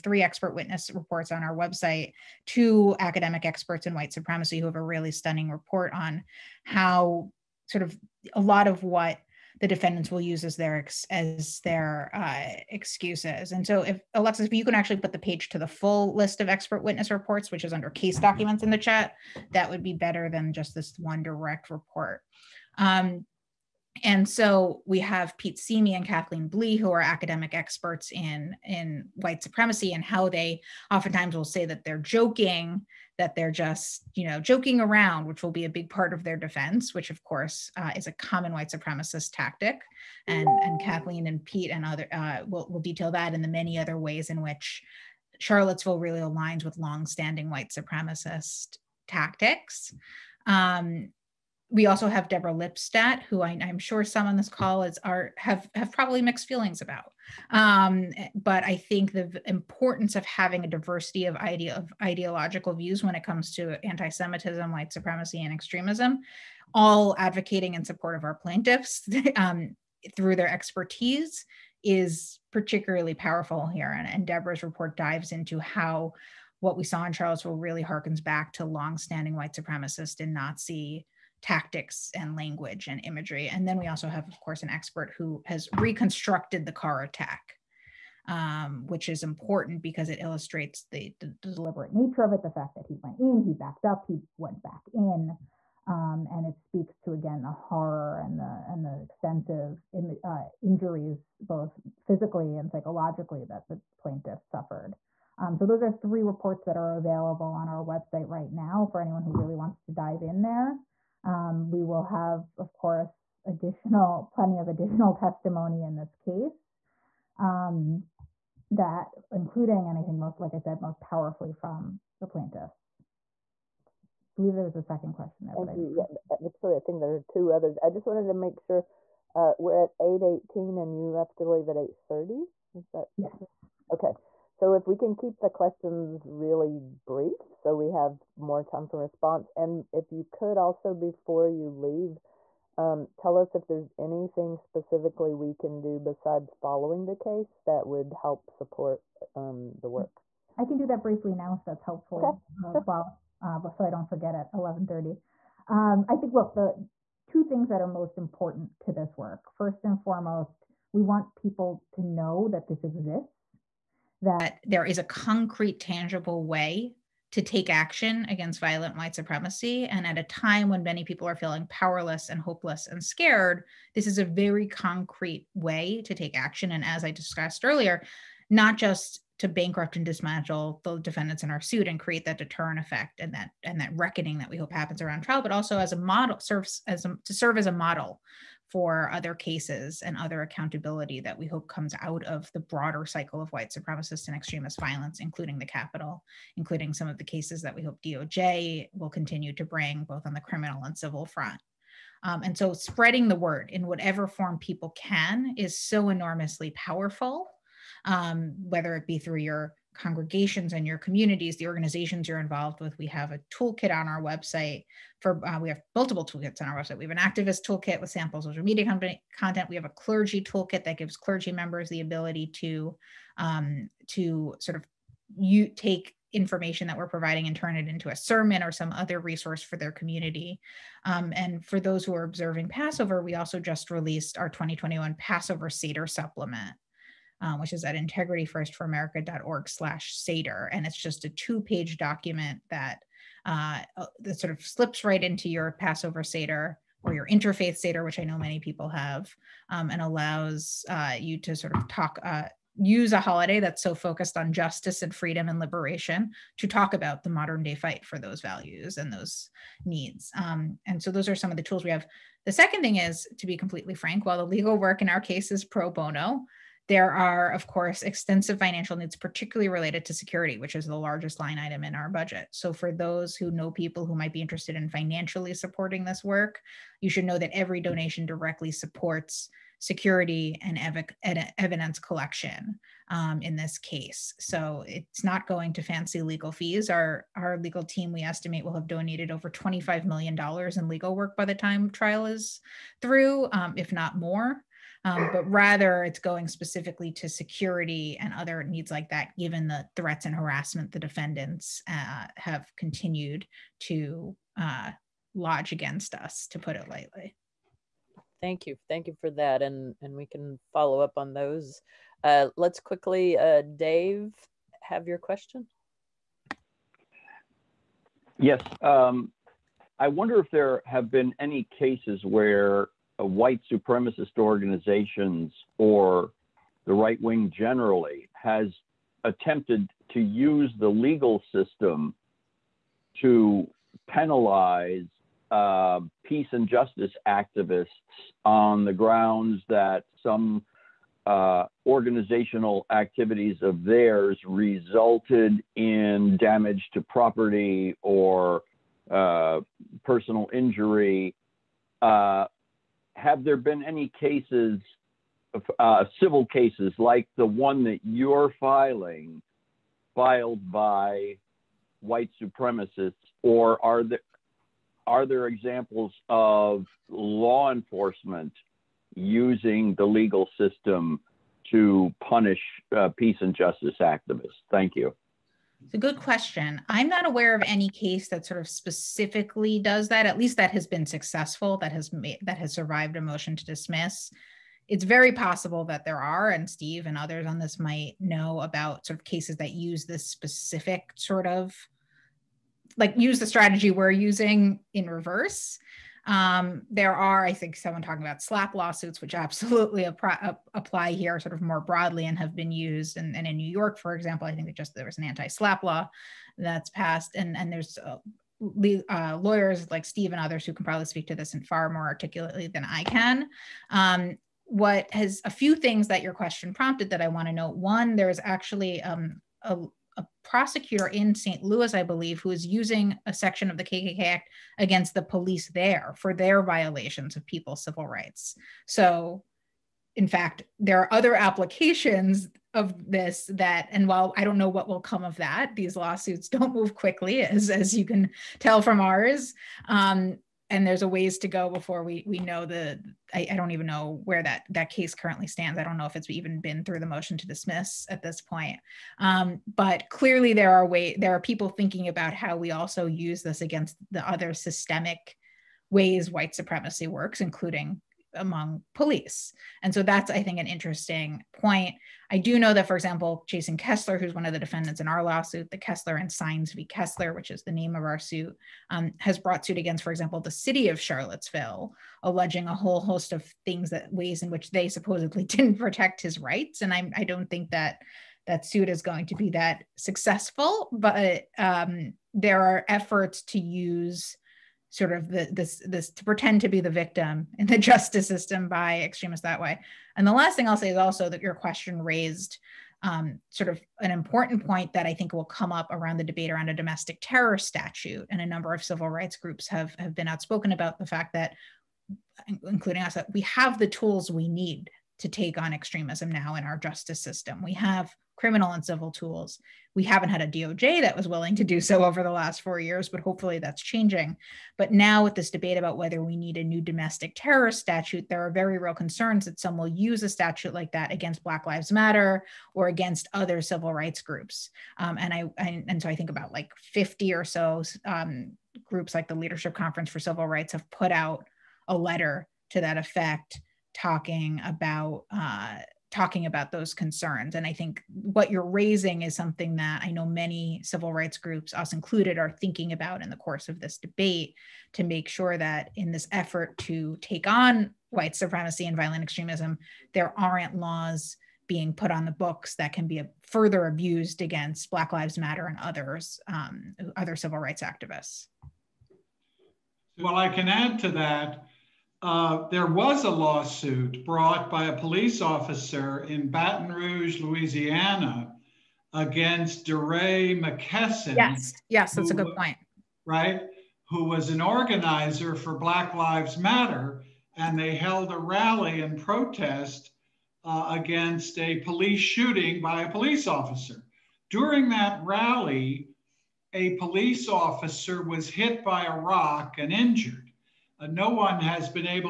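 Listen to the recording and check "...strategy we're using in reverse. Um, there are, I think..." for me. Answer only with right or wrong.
right.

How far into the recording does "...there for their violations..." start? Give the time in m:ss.
7:05.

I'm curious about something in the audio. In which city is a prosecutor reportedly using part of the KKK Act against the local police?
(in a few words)
St. Louis.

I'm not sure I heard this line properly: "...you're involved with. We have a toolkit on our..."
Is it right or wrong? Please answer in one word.
right.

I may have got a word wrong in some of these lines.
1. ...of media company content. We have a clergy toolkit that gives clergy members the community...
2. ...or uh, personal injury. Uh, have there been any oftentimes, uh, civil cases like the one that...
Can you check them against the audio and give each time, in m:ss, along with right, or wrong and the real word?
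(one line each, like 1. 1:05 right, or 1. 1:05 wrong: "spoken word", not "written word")
1. 3:38 wrong: "ability", not "community"
2. 5:48 wrong: "cases", not "oftentimes".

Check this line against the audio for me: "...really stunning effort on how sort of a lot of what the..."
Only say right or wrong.
wrong.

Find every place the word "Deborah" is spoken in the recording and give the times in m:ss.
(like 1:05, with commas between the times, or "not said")
0:52, 1:14.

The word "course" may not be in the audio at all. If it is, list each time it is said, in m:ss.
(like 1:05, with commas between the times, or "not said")
0:37, 1:24, 1:52, 4:27, 9:03.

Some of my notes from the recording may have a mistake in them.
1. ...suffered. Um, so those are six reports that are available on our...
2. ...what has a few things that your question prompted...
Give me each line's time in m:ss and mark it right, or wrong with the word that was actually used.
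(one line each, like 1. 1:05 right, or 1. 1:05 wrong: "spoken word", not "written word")
1. 1:44 wrong: "three", not "six"
2. 6:54 right.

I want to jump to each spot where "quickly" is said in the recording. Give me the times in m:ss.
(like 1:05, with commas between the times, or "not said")
5:12, 7:16.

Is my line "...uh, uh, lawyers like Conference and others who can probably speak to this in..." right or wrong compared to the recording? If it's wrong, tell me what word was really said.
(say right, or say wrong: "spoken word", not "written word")
wrong: "Steve", not "Conference".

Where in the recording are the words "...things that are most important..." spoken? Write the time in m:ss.
2:37.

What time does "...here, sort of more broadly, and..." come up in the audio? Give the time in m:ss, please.
6:41.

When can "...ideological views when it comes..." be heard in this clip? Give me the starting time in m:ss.
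1:02.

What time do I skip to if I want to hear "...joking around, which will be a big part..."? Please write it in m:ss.
0:34.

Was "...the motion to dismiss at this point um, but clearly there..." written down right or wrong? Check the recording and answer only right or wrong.
right.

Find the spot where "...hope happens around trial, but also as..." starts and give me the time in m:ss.
3:04.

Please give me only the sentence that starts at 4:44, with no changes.
So it's not going to fancy legal fees.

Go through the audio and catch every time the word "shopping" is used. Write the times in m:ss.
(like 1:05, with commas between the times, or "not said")
not said.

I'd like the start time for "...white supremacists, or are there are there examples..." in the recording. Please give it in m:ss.
6:02.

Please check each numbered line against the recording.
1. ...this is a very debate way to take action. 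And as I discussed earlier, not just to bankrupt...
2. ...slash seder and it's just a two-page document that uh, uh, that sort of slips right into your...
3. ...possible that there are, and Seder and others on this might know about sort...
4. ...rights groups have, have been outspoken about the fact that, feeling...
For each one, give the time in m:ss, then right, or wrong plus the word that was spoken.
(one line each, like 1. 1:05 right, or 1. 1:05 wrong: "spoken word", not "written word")
1. 2:53 wrong: "concrete", not "debate"
2. 3:59 right
3. 6:25 wrong: "Steve", not "Seder"
4. 8:19 wrong: "including", not "feeling".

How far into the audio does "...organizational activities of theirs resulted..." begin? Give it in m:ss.
5:41.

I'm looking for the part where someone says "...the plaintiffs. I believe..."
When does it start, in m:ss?
2:02.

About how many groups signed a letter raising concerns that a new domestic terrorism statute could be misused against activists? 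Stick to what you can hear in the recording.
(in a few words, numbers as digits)
50.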